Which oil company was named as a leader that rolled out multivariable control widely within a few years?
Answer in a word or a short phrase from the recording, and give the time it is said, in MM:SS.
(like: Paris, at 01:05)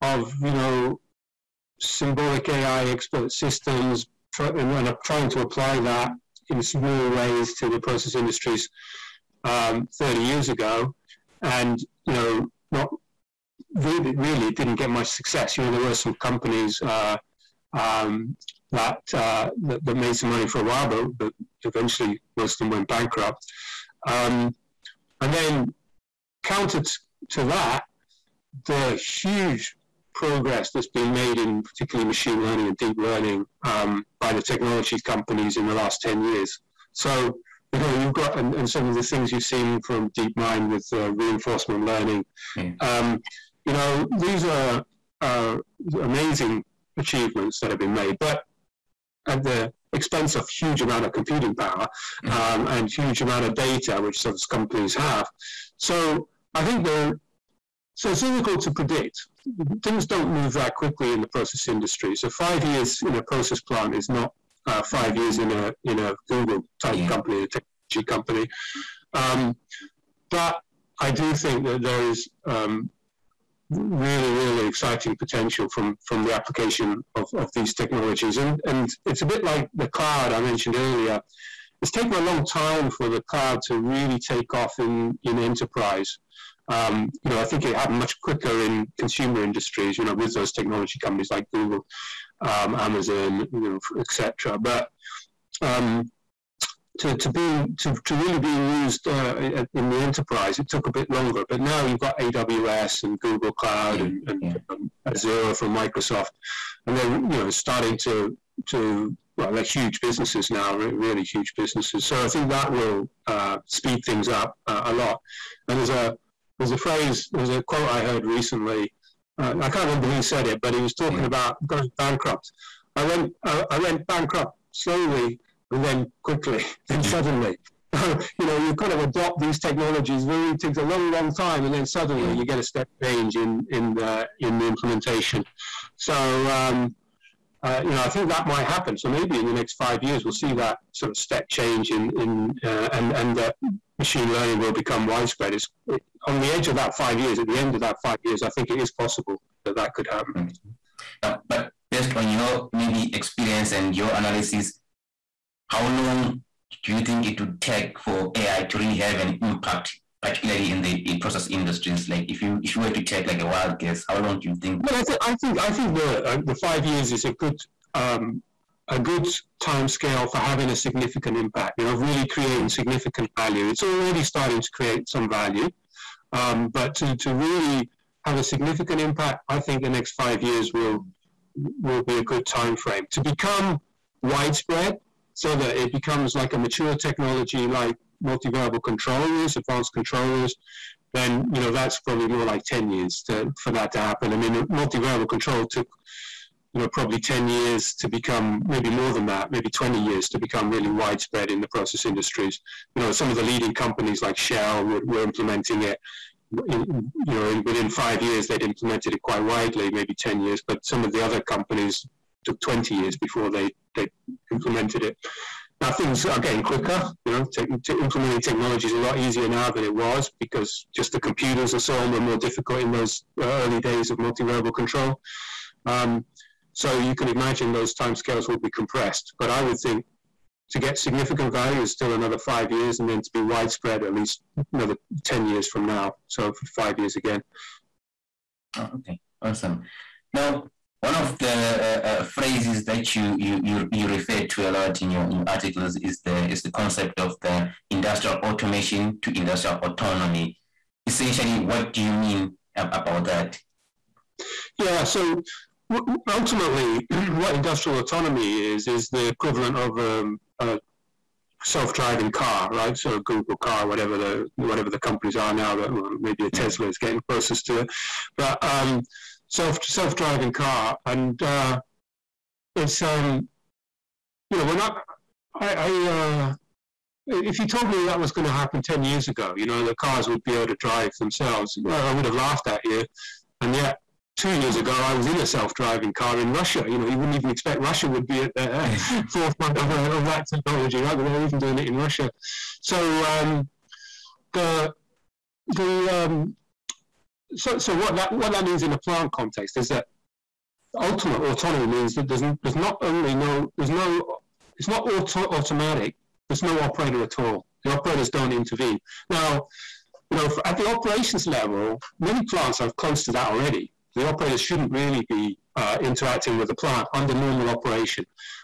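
Shell, at 03:24.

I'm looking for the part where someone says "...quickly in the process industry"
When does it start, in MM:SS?
01:00.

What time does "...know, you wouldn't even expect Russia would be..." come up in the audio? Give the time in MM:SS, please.
04:46.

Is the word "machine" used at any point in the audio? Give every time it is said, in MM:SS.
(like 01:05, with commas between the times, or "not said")
00:32, 02:23.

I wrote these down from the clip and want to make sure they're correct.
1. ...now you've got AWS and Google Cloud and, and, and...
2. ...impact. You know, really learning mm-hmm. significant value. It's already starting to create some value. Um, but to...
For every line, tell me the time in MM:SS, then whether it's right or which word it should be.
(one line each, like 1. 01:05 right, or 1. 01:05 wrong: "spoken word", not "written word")
1. 01:41 right
2. 02:51 wrong: "creating", not "learning".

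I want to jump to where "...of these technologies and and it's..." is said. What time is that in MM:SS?
01:17.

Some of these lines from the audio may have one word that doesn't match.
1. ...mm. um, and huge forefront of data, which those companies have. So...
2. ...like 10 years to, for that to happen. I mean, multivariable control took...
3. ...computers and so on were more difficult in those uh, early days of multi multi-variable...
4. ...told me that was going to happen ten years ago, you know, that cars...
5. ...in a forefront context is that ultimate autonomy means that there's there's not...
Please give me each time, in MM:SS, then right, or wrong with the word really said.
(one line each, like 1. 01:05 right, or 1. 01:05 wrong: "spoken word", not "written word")
1. 00:52 wrong: "amount", not "forefront"
2. 03:12 right
3. 03:41 right
4. 04:37 right
5. 04:58 wrong: "plant", not "forefront".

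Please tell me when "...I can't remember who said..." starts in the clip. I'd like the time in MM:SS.
01:59.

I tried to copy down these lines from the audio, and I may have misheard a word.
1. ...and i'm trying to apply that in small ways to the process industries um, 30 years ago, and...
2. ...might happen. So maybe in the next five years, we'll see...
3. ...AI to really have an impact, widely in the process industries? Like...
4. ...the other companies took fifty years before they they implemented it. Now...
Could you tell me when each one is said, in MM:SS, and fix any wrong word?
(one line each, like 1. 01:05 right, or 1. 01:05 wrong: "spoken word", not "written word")
1. 00:04 right
2. 02:18 right
3. 02:38 wrong: "particularly", not "widely"
4. 03:31 wrong: "twenty", not "fifty".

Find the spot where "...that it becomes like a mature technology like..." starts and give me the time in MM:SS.
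03:05.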